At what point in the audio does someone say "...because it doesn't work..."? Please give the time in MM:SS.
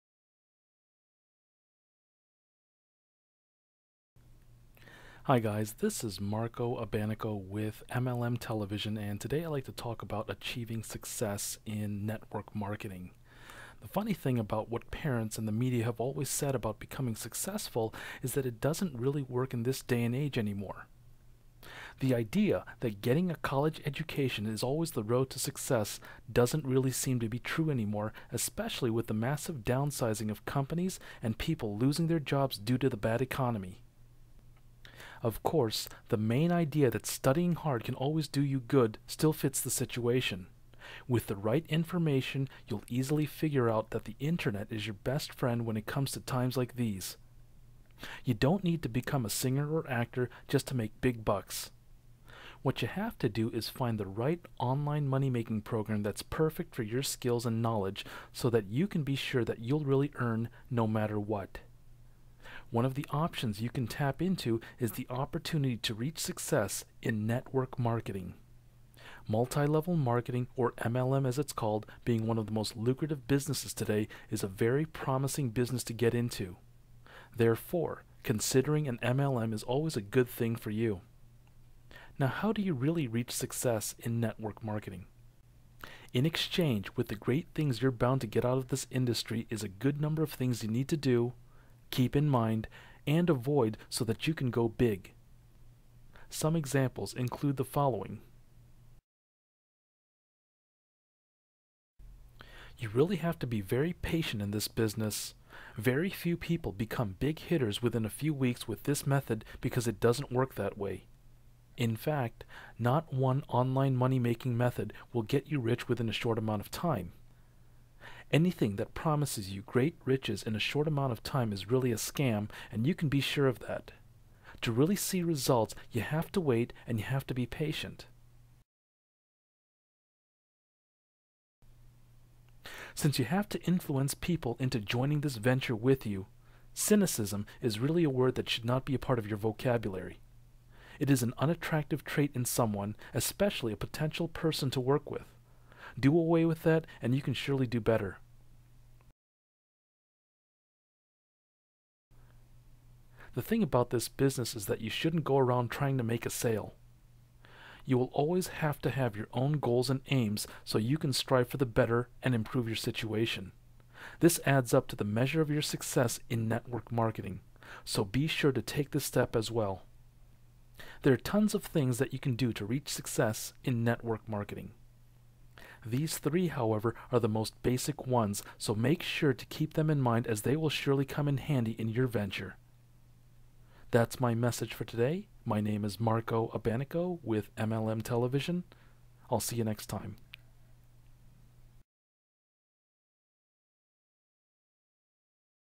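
01:49.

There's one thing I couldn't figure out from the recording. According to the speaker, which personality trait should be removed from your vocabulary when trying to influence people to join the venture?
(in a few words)
Cynicism.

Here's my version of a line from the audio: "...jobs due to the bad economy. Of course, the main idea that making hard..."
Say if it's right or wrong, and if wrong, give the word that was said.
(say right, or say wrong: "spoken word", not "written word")
wrong: "studying", not "making".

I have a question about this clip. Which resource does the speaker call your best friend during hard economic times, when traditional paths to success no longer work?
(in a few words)
The internet.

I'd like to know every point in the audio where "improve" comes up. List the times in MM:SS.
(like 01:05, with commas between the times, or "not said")
02:42.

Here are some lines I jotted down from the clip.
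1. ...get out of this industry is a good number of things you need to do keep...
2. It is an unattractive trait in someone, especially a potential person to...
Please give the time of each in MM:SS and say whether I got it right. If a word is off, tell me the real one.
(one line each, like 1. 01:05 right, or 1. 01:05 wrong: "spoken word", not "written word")
1. 01:28 right
2. 02:20 right.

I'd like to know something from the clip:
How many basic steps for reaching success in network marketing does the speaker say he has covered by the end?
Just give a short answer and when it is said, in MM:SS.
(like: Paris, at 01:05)
3, at 02:56.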